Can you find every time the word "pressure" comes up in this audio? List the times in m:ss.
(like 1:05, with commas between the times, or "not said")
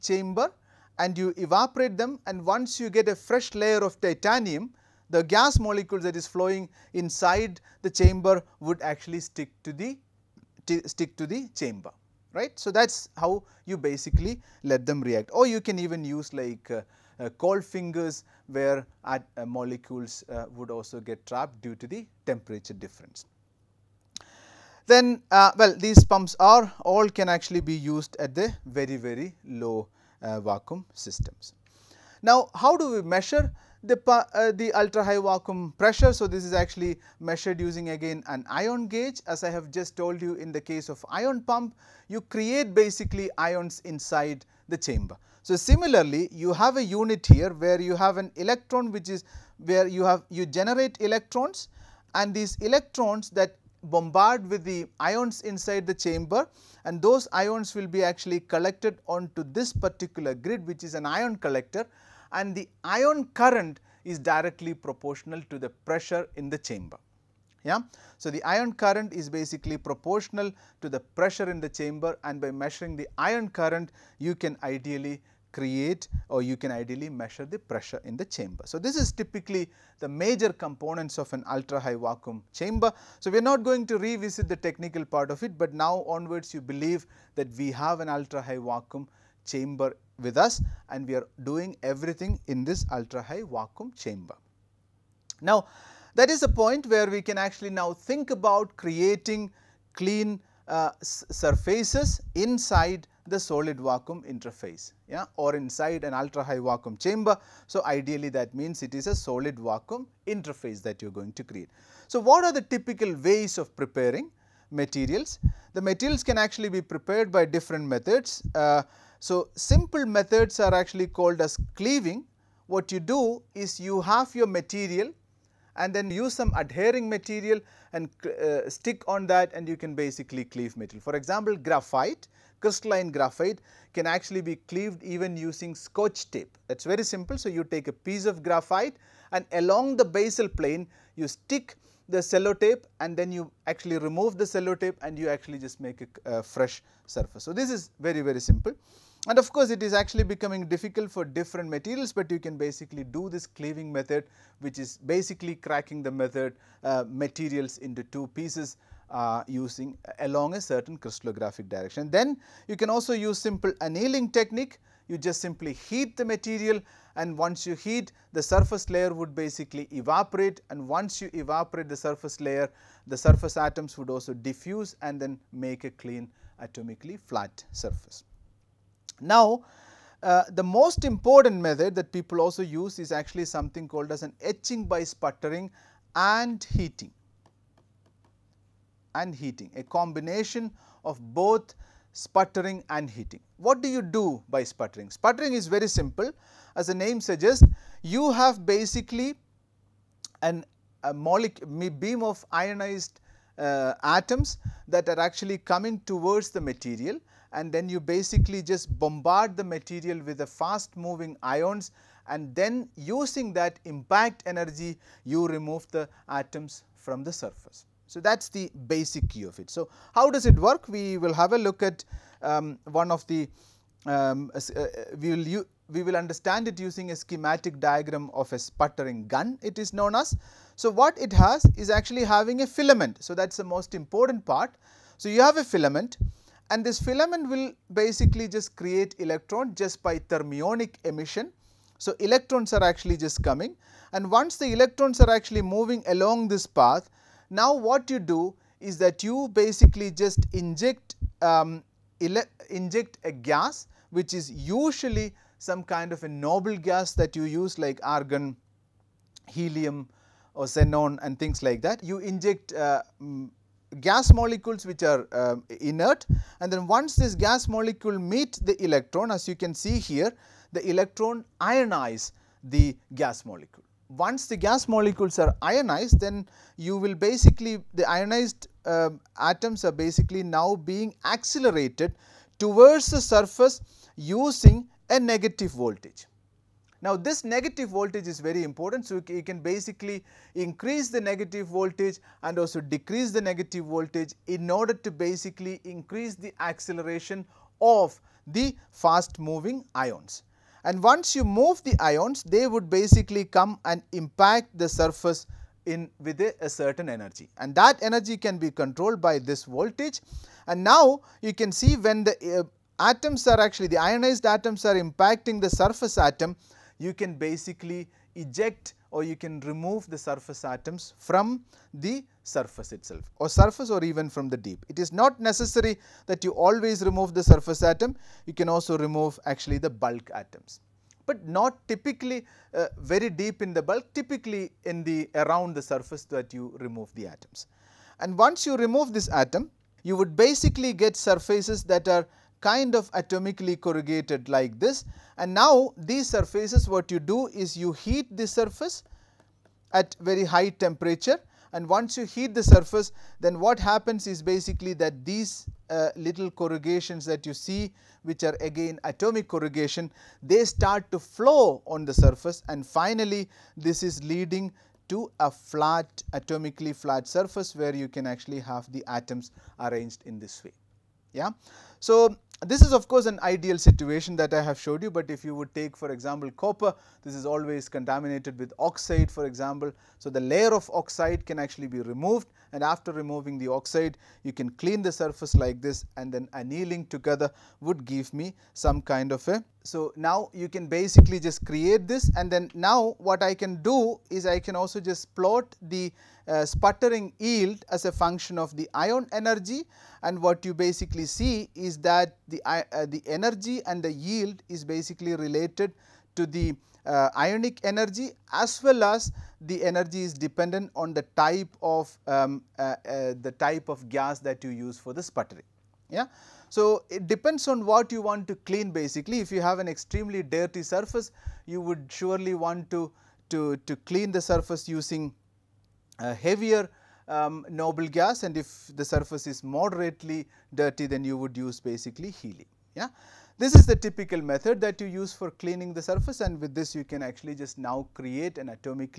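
0:35, 1:05, 1:11, 1:17.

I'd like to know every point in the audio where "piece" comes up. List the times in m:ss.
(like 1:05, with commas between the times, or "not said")
2:17, 2:38.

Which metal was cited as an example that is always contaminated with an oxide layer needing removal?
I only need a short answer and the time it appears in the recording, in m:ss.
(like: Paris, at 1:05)
copper, at 6:16.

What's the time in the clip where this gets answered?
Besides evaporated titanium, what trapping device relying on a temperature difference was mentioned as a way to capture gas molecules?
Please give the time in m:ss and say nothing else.
0:17.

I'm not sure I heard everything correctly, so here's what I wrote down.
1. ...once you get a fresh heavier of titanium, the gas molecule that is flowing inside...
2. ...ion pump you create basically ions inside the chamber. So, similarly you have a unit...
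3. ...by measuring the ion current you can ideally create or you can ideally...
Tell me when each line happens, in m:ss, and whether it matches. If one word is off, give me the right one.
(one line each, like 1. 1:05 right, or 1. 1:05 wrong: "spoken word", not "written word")
1. 0:02 wrong: "layer", not "heavier"
2. 0:41 right
3. 1:12 right.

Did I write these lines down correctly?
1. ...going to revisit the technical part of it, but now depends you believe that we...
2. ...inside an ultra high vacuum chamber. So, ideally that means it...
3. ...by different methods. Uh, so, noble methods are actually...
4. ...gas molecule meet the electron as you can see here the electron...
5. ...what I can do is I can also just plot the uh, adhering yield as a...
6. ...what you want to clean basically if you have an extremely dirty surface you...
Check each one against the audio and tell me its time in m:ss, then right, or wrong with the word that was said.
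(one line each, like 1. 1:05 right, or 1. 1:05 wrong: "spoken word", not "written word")
1. 1:23 wrong: "onwards", not "depends"
2. 1:45 right
3. 1:57 wrong: "simple", not "noble"
4. 4:27 right
5. 6:33 wrong: "sputtering", not "adhering"
6. 6:57 right.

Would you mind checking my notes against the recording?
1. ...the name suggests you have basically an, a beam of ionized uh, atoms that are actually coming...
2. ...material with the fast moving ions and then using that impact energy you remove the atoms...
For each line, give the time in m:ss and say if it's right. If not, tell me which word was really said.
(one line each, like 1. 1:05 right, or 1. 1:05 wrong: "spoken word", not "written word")
1. 3:16 right
2. 3:29 right.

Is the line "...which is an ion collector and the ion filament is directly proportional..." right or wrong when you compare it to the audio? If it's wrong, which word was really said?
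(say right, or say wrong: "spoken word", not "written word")
wrong: "current", not "filament".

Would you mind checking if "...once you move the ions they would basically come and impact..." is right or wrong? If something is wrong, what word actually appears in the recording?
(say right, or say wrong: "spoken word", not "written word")
right.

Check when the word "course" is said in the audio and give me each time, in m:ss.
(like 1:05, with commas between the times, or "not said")
2:29, 6:13.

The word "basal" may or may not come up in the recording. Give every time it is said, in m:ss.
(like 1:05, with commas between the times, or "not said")
2:20.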